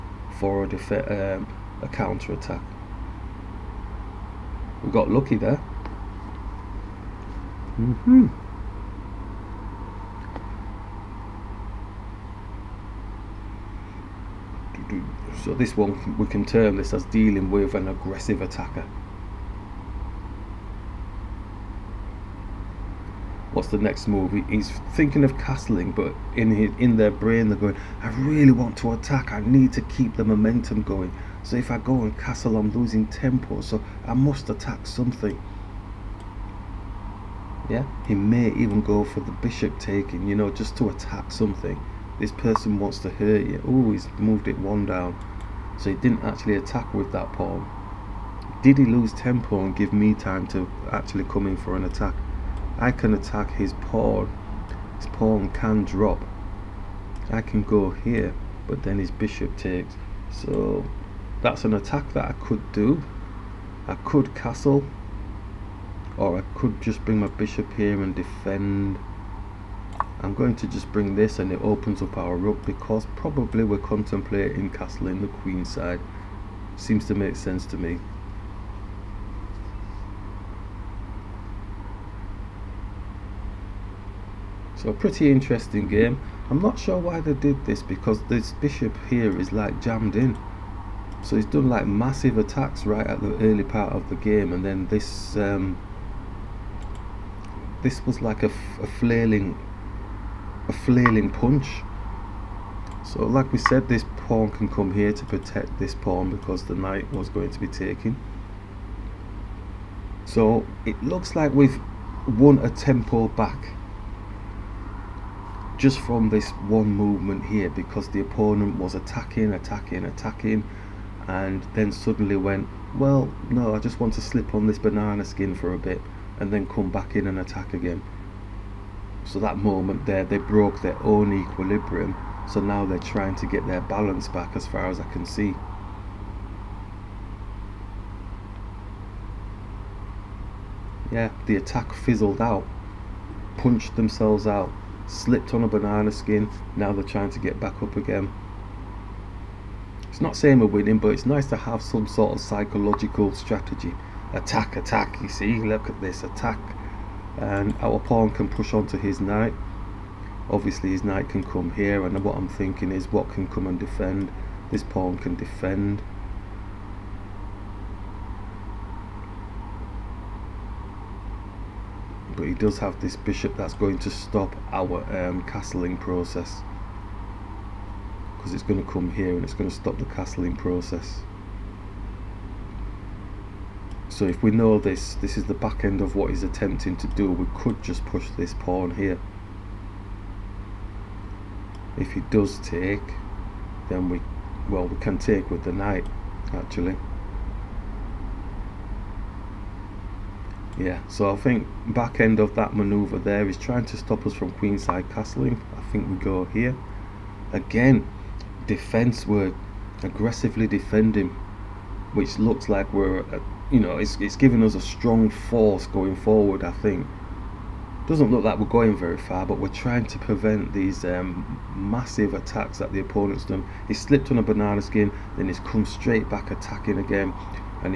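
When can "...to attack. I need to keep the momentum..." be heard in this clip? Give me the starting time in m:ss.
0:28.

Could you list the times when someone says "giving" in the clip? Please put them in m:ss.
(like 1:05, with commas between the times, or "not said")
3:34.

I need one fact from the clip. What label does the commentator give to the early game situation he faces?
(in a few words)
dealing with an aggressive attacker.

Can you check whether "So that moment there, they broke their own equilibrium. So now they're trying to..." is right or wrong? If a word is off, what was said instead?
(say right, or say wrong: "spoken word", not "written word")
right.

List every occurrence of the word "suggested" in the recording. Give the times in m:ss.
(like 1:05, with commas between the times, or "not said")
not said.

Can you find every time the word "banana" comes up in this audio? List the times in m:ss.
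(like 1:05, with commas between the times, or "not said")
2:04, 2:25, 3:44.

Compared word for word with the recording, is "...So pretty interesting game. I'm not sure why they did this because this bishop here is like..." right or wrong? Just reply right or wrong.
right.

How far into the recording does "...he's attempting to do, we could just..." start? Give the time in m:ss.
3:06.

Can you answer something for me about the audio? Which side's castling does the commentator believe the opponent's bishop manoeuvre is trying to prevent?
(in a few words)
queenside.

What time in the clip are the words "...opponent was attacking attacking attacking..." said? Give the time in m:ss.
1:58.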